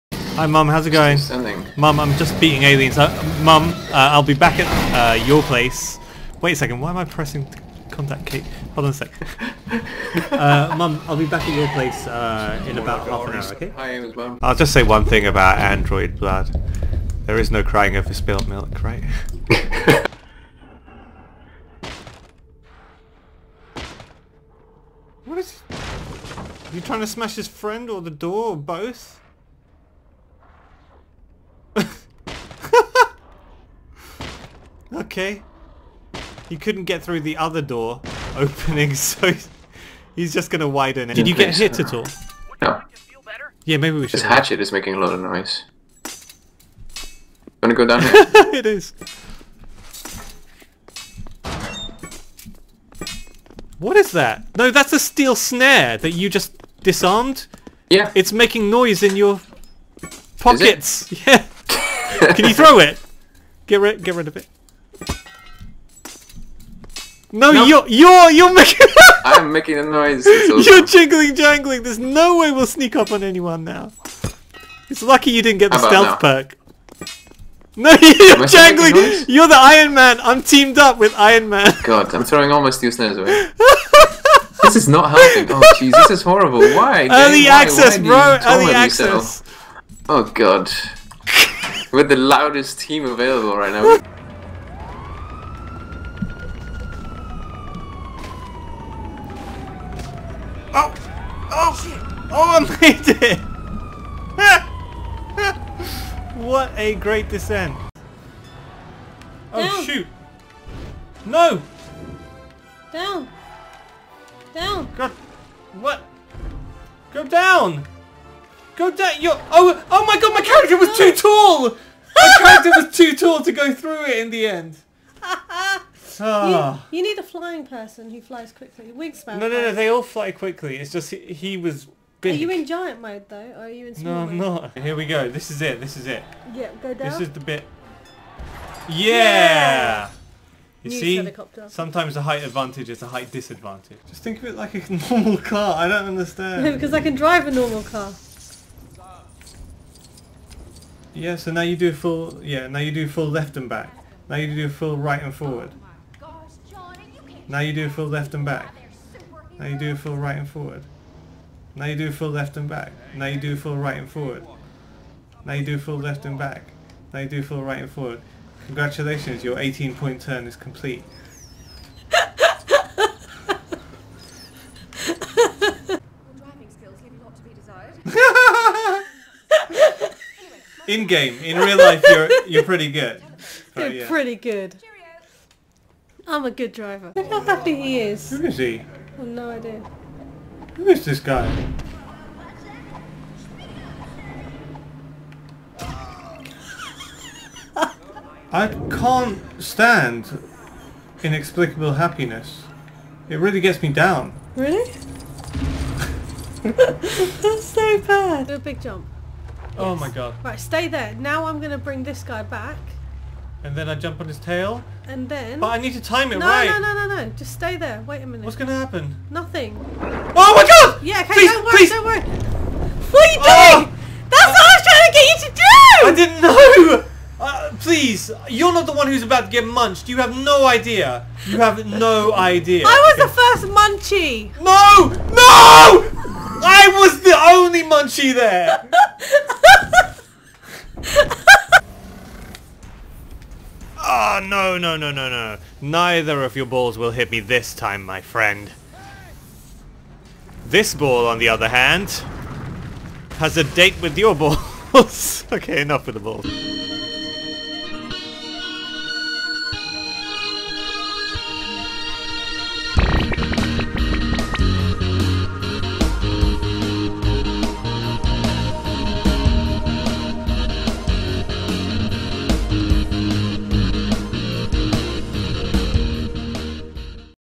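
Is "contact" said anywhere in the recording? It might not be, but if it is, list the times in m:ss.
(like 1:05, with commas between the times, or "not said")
0:07.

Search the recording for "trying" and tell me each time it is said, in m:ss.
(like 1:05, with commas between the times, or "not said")
0:26, 3:44.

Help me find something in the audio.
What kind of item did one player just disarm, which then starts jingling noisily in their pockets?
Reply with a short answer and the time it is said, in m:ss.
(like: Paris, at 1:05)
steel snare, at 0:54.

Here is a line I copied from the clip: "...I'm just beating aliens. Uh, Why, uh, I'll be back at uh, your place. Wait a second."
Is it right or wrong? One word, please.
wrong.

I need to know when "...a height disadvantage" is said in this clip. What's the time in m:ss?
2:23.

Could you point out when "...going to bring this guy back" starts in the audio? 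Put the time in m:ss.
3:31.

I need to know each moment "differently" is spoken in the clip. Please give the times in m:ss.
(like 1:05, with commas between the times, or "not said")
not said.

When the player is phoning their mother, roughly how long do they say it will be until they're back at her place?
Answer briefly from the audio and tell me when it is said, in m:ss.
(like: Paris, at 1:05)
half an hour, at 0:13.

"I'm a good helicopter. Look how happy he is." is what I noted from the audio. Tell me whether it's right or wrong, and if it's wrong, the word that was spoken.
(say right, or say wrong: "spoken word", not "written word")
wrong: "driver", not "helicopter".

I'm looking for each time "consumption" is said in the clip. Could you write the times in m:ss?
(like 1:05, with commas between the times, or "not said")
not said.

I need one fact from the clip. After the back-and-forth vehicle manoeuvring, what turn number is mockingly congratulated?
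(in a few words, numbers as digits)
18.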